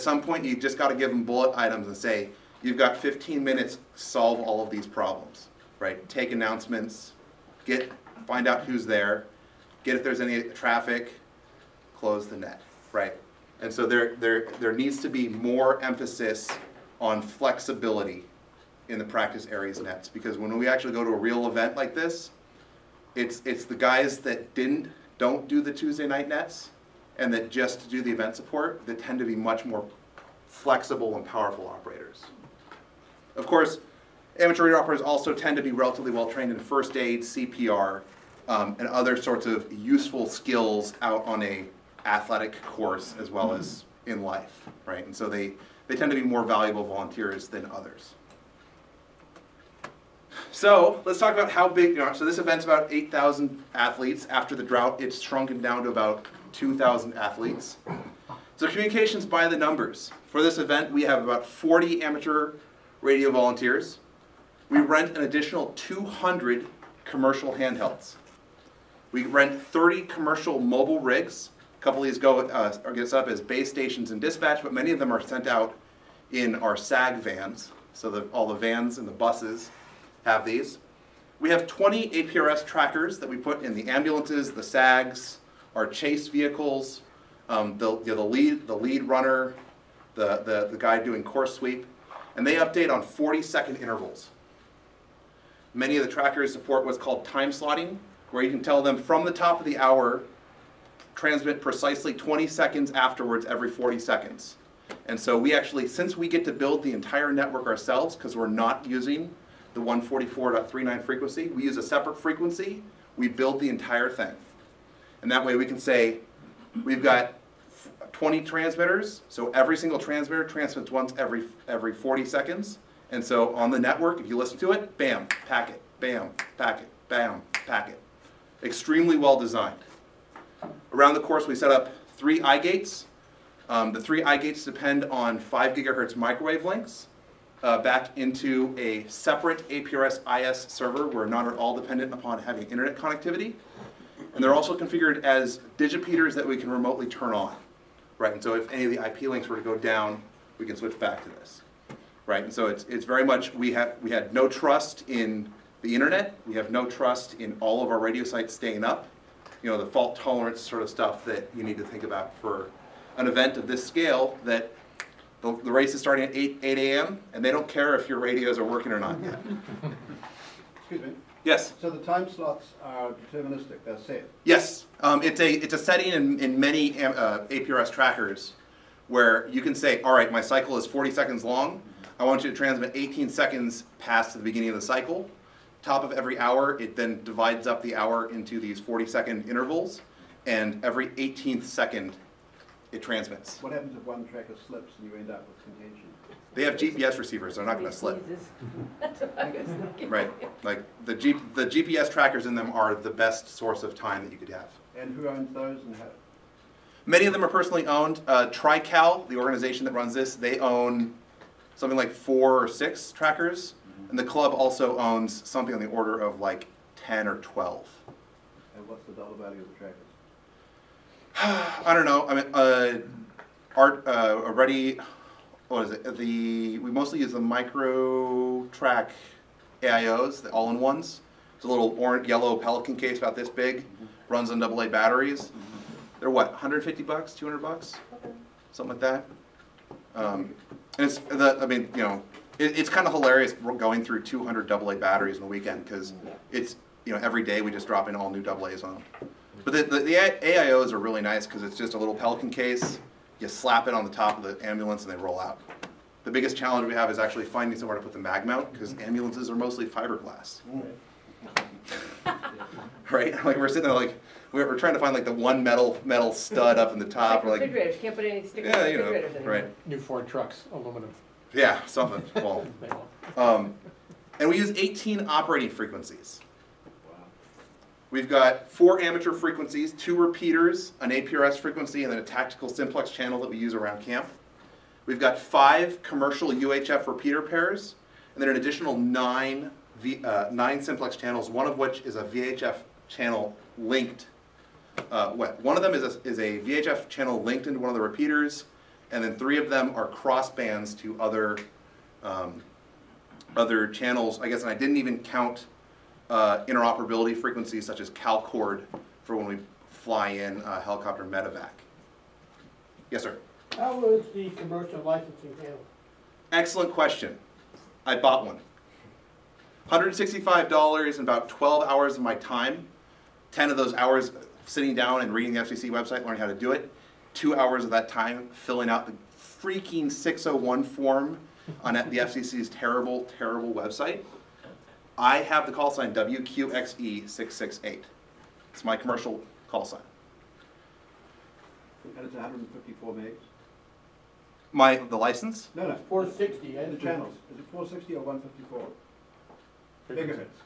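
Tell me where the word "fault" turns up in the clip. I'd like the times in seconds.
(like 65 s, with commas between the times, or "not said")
159 s.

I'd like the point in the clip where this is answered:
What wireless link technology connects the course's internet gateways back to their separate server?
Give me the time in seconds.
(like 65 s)
135 s.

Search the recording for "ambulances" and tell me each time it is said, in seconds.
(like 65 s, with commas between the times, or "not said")
83 s, 254 s, 258 s.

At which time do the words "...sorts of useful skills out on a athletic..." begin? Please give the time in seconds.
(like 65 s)
39 s.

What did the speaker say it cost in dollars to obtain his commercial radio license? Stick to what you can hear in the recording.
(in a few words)
$165.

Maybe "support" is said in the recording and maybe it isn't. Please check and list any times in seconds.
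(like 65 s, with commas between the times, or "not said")
28 s, 96 s.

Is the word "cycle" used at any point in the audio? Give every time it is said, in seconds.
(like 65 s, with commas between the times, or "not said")
180 s, 184 s.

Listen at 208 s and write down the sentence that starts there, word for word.
Uh, TriCal, the organization that runs this, they own something like four or six trackers, mm -hmm.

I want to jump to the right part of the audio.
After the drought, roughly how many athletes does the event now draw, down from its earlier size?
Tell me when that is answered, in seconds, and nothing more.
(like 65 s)
55 s.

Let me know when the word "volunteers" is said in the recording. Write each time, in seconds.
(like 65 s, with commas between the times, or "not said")
46 s, 63 s.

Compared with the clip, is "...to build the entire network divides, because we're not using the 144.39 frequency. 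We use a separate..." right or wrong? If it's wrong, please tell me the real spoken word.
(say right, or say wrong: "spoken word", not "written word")
wrong: "ourselves", not "divides".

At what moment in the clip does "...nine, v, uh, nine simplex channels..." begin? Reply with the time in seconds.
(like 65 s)
288 s.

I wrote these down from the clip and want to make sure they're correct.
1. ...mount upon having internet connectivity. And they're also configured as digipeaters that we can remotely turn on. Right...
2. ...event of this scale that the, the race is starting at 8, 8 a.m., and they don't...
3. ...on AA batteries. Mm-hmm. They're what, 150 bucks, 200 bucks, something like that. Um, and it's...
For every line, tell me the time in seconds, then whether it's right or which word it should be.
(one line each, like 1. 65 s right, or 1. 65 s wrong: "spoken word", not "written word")
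1. 141 s wrong: "dependent", not "mount"
2. 163 s right
3. 234 s right.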